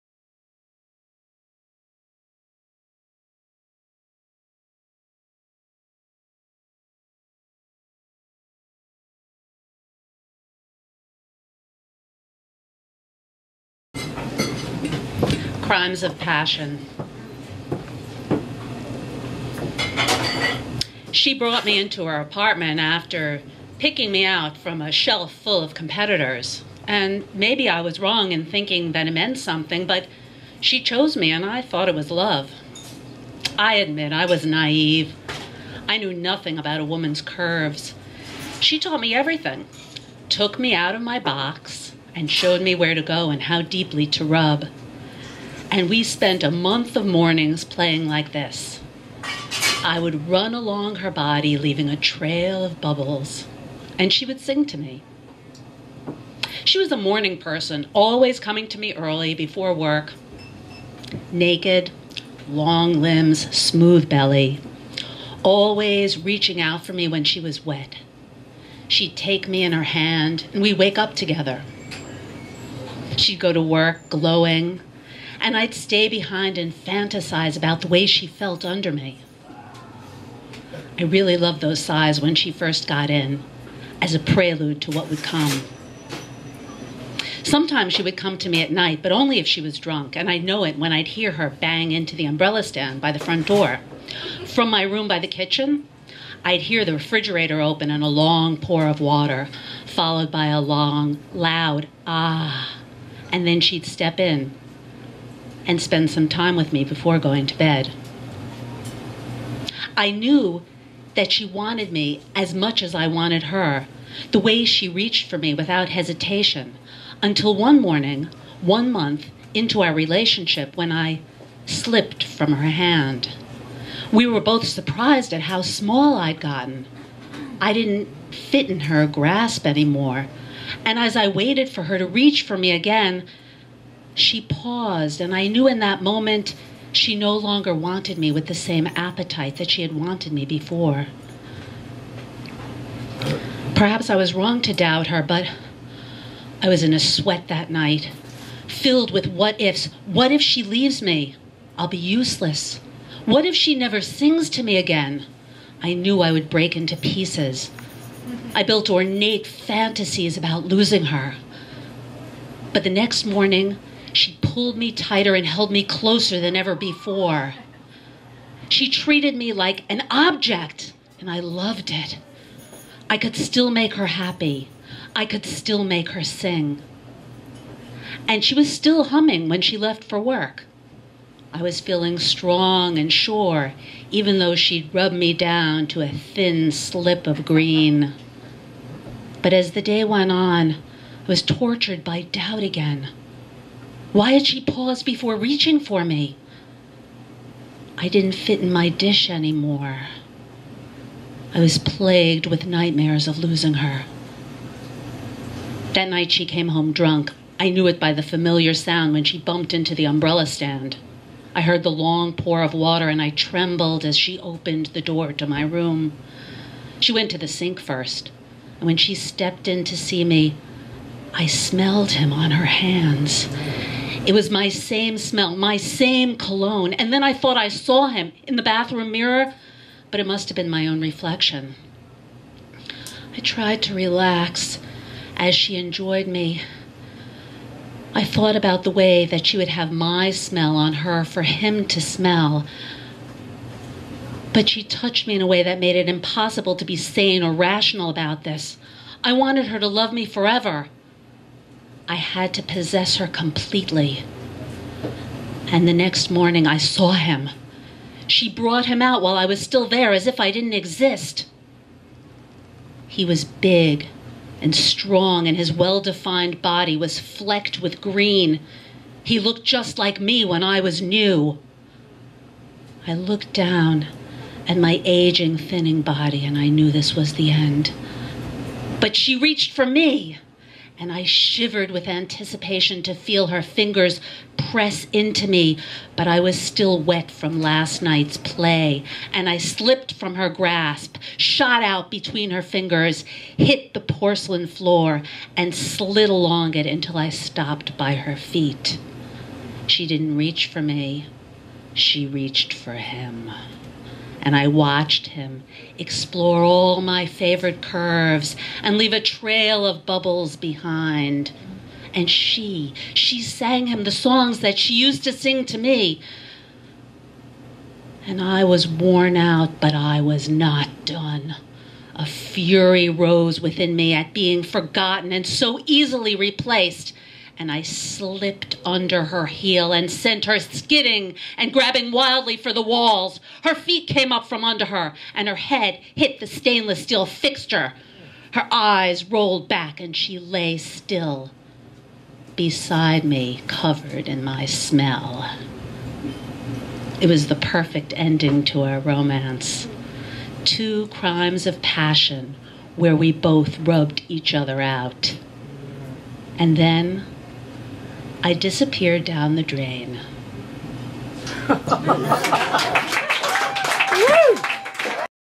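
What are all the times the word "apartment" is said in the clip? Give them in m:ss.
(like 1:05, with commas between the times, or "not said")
0:22.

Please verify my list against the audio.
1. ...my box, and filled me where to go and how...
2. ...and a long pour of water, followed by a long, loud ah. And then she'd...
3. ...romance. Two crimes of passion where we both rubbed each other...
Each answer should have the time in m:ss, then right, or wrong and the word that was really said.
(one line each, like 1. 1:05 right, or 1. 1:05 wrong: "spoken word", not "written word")
1. 0:41 wrong: "showed", not "filled"
2. 1:37 right
3. 5:48 right.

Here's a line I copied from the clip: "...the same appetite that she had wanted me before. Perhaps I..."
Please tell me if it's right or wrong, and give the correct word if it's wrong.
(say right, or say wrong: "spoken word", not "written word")
right.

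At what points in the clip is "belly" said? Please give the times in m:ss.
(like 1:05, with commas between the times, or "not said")
1:04.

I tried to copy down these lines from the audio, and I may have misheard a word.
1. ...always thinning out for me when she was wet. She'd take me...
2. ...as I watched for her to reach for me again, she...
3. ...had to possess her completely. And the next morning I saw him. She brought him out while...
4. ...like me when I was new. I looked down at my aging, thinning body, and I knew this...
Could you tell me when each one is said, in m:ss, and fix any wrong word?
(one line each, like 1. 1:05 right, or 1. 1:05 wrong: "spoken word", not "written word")
1. 1:05 wrong: "reaching", not "thinning"
2. 2:10 wrong: "waited", not "watched"
3. 4:12 right
4. 4:29 right.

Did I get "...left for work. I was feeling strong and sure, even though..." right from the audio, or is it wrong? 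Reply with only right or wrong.
right.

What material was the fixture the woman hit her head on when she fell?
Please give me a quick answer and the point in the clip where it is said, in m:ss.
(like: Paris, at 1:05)
stainless steel, at 5:36.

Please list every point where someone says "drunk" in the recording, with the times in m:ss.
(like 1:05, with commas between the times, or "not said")
1:29, 3:26.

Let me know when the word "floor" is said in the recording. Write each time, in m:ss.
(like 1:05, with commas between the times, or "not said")
4:54.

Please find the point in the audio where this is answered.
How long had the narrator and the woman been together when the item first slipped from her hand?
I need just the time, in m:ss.
1:58.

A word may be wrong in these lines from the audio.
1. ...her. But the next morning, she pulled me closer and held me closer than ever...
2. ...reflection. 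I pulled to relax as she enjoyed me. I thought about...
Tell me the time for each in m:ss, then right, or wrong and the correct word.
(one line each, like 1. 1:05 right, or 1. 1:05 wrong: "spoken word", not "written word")
1. 2:41 wrong: "tighter", not "closer"
2. 3:51 wrong: "tried", not "pulled".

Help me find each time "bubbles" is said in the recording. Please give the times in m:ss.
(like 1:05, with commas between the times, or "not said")
0:52, 5:10.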